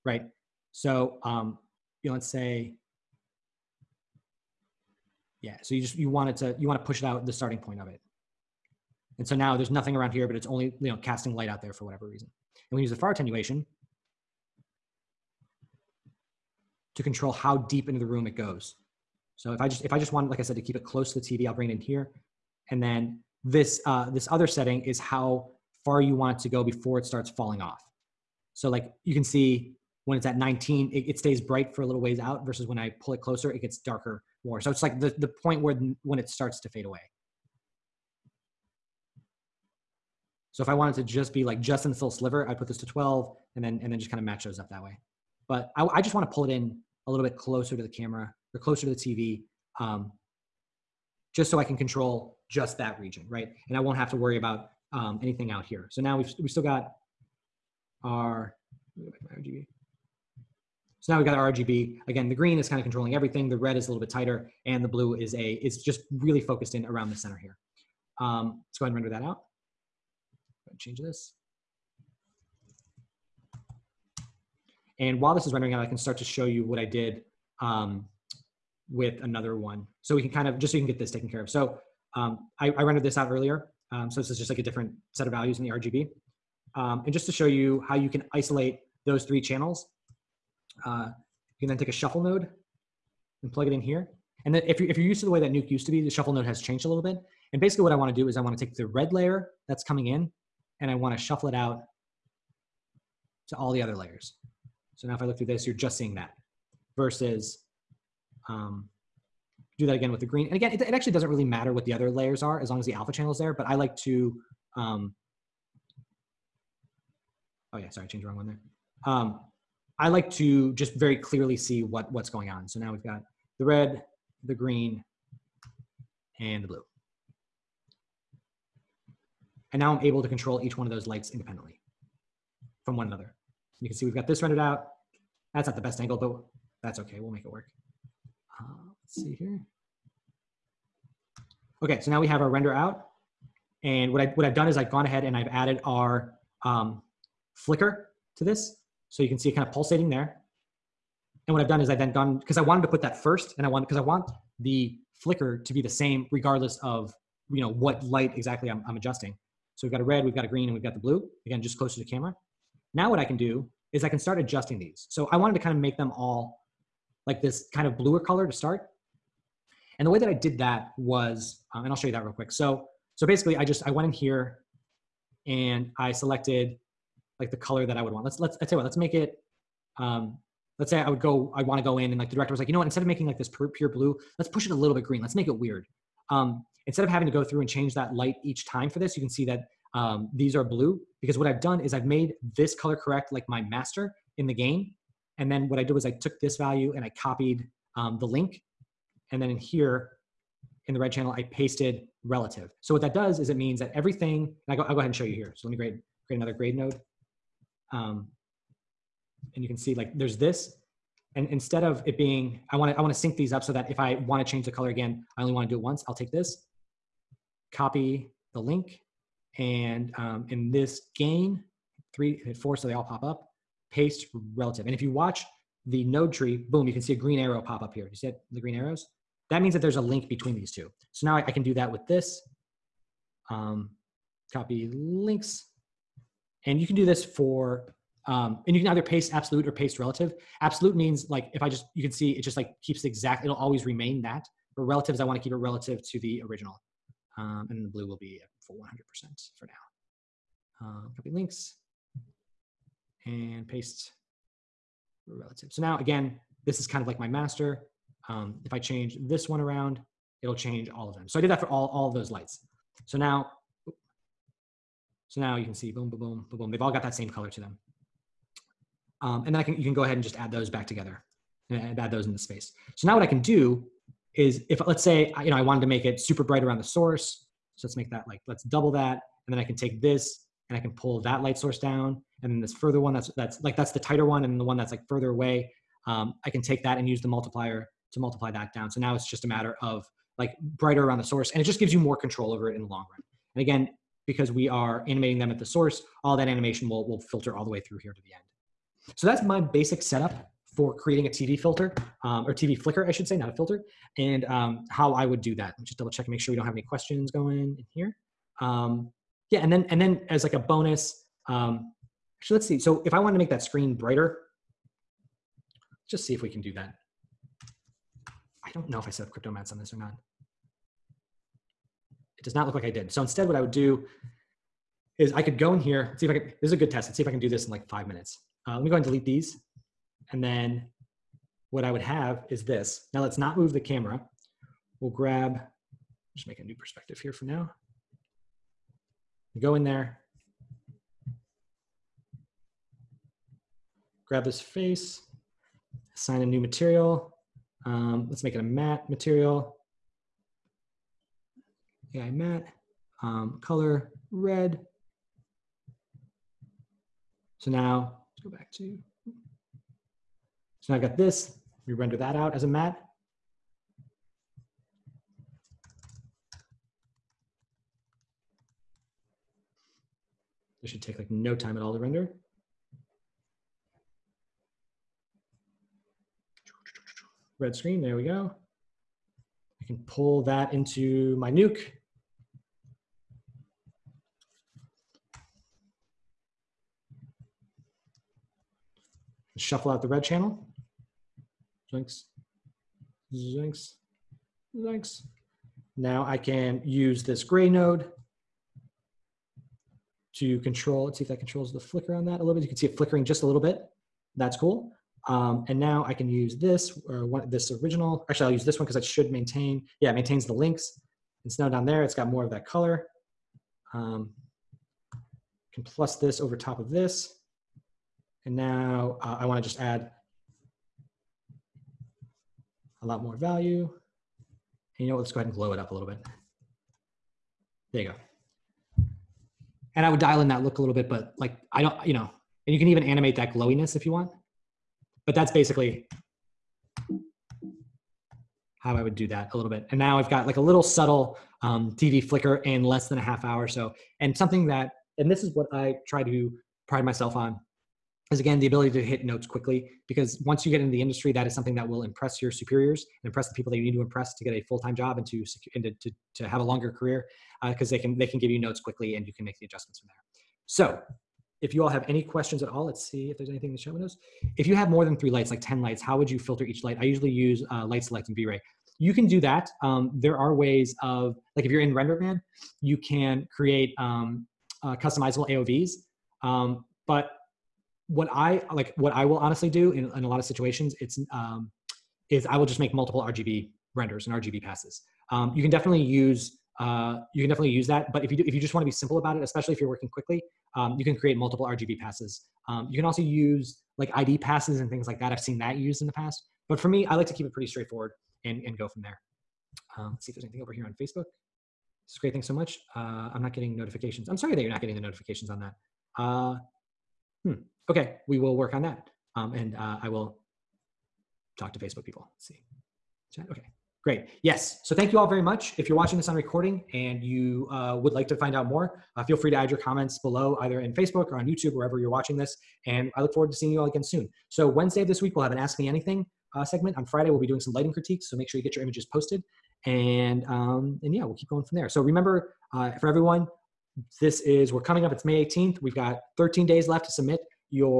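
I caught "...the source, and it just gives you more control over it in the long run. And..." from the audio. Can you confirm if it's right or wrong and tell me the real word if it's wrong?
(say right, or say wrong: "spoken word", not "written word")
right.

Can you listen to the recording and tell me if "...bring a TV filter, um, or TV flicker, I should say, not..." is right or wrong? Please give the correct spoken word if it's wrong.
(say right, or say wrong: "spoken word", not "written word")
wrong: "creating", not "bring".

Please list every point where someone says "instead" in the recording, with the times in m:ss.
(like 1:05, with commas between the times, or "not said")
3:02, 3:06, 3:31, 5:23.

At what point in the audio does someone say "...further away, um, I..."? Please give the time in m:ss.
4:45.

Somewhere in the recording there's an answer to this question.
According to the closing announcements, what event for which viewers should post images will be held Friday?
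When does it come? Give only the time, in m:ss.
8:47.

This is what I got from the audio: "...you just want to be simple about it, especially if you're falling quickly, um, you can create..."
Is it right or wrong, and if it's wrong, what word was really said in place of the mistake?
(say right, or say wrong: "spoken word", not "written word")
wrong: "working", not "falling".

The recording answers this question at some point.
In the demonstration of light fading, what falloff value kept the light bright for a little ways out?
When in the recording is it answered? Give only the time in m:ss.
0:30.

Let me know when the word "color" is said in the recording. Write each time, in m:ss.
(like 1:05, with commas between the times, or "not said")
2:48, 2:57, 3:12, 3:34, 4:27, 5:53, 6:52.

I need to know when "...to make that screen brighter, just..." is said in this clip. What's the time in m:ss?
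5:13.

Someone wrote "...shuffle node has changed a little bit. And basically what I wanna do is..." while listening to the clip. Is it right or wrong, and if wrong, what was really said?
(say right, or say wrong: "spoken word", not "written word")
right.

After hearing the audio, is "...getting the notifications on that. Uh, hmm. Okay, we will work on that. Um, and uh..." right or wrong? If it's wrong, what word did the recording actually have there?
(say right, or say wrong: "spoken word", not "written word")
right.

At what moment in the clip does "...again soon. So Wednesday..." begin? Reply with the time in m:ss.
8:43.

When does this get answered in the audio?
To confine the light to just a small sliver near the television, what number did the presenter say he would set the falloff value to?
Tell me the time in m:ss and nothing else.
0:42.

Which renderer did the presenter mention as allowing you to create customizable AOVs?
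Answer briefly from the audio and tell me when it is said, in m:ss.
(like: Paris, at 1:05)
RenderMan, at 7:51.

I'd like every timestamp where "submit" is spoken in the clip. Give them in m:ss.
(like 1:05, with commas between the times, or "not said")
8:57.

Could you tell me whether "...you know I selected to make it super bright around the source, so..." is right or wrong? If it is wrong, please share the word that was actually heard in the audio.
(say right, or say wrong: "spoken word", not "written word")
wrong: "wanted", not "selected".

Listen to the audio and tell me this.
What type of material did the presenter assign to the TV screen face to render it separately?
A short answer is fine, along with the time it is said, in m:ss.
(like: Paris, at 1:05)
Matte material, at 5:48.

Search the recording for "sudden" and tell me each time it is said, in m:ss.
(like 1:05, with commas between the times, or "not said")
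not said.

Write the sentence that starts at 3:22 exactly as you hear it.
So what that does is it means that everything, and I go, I'll go ahead and show you here.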